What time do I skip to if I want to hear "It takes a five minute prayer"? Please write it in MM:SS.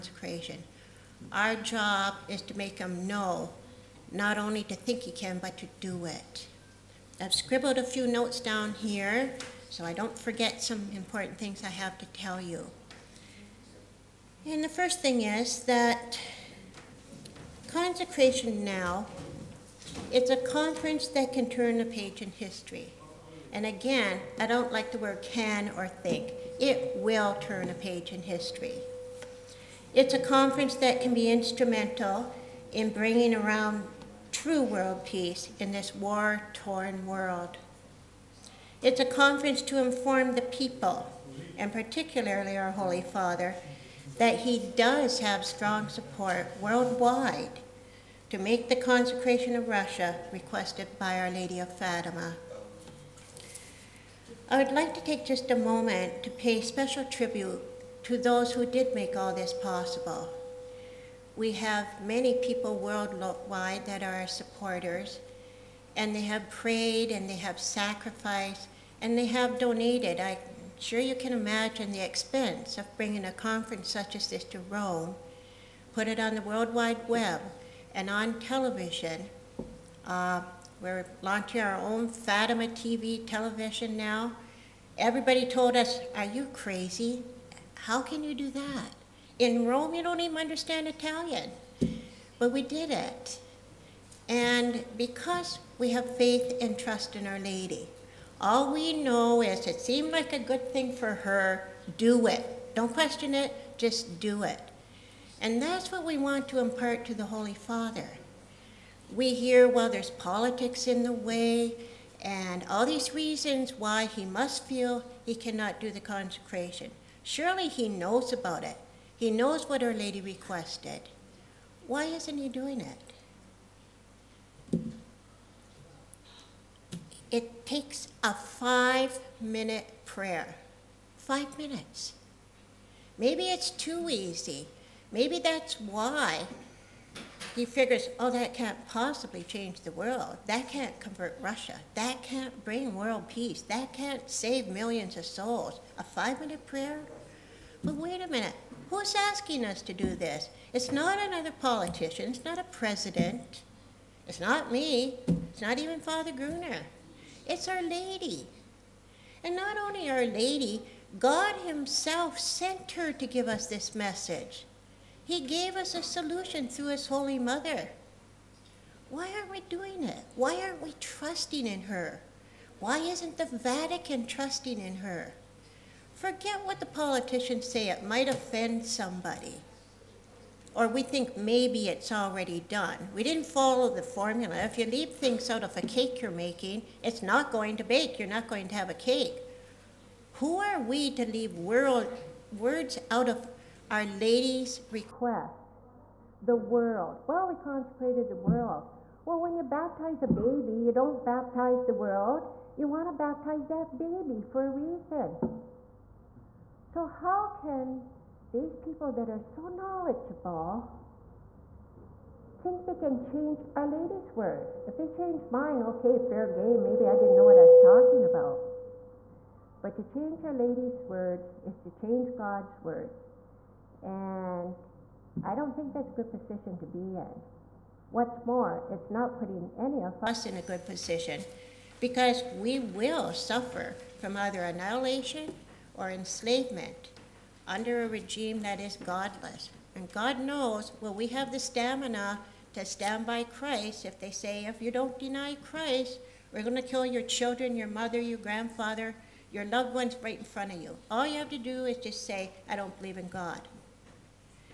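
02:07.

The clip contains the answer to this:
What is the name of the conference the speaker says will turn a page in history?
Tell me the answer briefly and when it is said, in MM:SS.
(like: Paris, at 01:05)
Consecration Now, at 00:17.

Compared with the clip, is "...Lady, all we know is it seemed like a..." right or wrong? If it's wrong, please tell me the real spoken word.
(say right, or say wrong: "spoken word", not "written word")
right.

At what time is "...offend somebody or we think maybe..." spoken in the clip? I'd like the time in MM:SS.
02:58.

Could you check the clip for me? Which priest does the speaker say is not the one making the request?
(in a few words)
Father Gruner.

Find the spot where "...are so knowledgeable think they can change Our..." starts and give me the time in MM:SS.
03:29.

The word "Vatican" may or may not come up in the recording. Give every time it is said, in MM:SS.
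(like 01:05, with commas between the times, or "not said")
02:53.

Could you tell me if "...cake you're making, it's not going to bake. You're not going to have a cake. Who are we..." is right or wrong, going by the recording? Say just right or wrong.
right.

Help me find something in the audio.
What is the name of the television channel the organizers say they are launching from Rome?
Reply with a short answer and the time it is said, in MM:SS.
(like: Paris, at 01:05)
Fatima TV, at 01:22.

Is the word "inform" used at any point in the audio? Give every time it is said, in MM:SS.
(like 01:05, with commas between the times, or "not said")
00:39.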